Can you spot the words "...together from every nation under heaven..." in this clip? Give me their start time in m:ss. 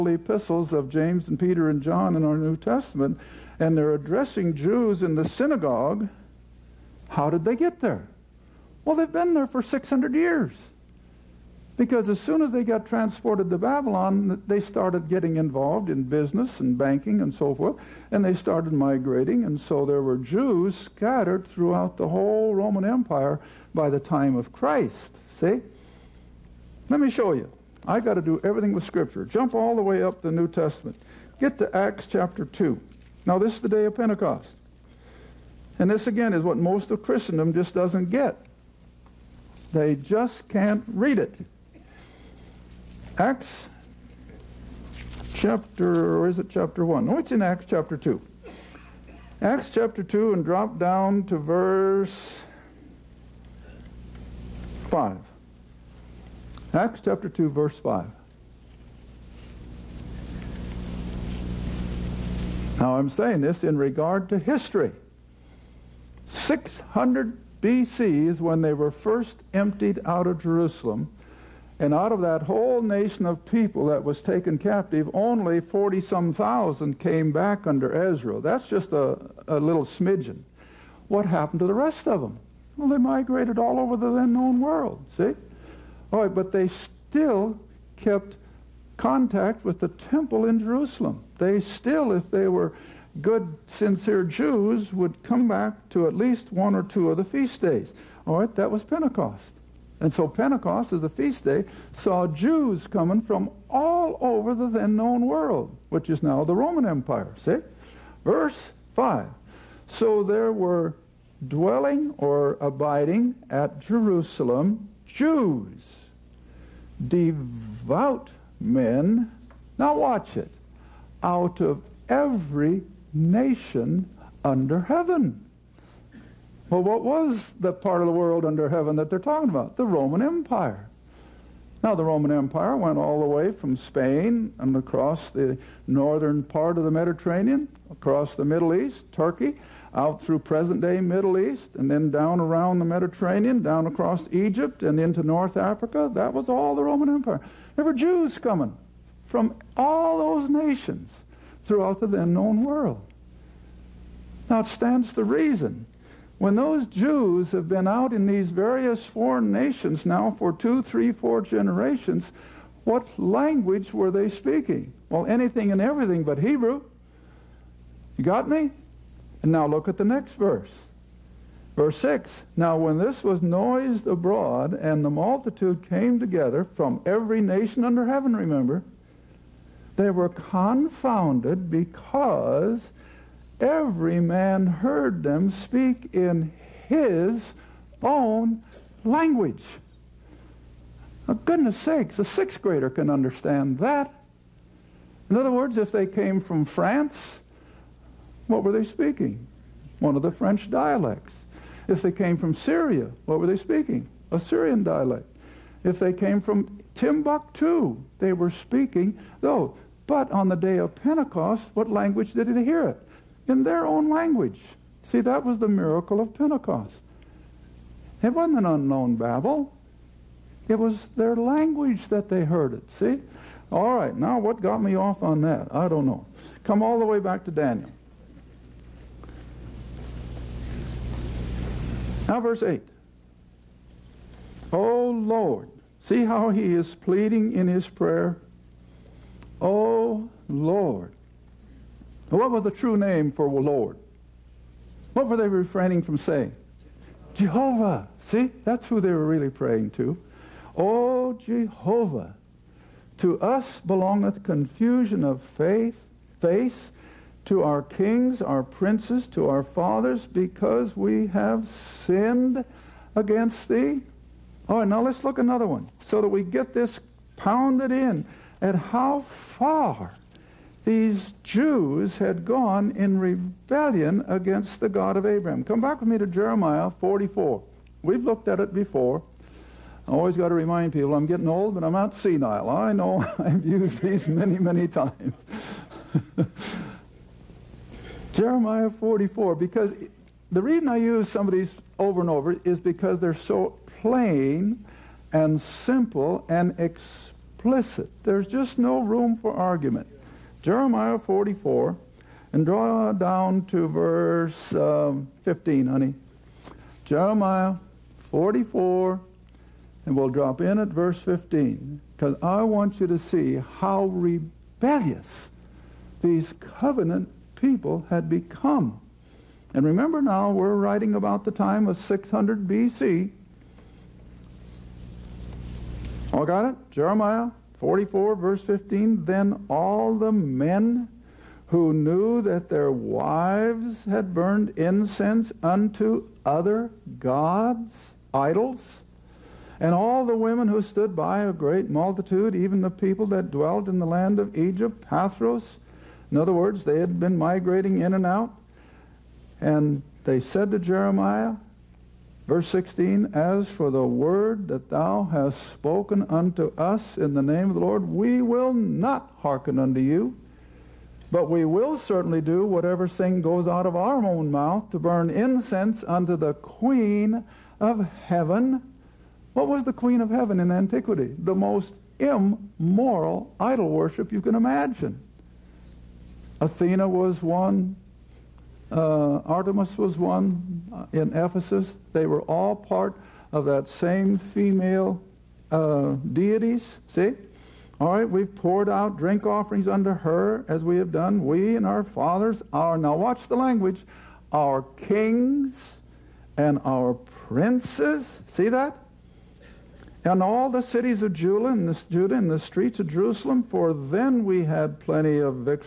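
2:56.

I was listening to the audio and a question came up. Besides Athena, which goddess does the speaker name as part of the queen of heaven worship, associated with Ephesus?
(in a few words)
Artemis.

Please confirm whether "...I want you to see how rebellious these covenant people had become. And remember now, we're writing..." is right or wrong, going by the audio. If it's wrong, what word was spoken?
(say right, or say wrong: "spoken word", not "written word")
right.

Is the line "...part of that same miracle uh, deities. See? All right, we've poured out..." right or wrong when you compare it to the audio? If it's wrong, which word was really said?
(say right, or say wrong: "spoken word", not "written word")
wrong: "female", not "miracle".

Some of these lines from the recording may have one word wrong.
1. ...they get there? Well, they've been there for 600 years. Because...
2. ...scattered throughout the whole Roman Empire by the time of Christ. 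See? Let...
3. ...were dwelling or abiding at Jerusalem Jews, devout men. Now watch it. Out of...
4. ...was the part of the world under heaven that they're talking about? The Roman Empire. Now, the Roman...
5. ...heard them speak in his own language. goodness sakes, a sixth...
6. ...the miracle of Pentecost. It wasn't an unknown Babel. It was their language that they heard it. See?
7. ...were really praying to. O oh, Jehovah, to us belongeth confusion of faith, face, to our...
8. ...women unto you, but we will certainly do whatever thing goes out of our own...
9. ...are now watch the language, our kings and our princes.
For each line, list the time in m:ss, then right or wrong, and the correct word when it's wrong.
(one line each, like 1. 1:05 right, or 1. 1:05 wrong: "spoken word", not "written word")
1. 0:07 right
2. 0:20 right
3. 1:50 right
4. 2:07 right
5. 3:04 right
6. 3:35 right
7. 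4:09 right
8. 5:59 wrong: "hearken", not "women"
9. 6:32 right.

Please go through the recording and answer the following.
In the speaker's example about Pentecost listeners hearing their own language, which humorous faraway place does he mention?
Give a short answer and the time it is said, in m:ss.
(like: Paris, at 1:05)
Timbuktu, at 3:26.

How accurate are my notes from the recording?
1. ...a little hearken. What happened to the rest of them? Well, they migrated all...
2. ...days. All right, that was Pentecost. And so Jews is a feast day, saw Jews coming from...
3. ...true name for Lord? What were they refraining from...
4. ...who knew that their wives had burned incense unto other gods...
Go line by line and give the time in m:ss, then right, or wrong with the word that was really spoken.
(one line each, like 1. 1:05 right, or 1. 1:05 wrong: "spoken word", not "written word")
1. 1:19 wrong: "smidgen", not "hearken"
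2. 1:37 wrong: "Pentecost", not "Jews"
3. 4:02 right
4. 5:31 right.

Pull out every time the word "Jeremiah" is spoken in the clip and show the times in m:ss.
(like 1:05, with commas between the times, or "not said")
4:36, 4:48, 5:00, 5:07, 5:26, 5:50.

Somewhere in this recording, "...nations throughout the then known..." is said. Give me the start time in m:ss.
2:30.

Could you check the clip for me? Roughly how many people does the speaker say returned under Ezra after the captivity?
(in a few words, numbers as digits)
40 some thousand.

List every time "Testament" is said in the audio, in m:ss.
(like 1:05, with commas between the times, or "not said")
0:02, 0:30.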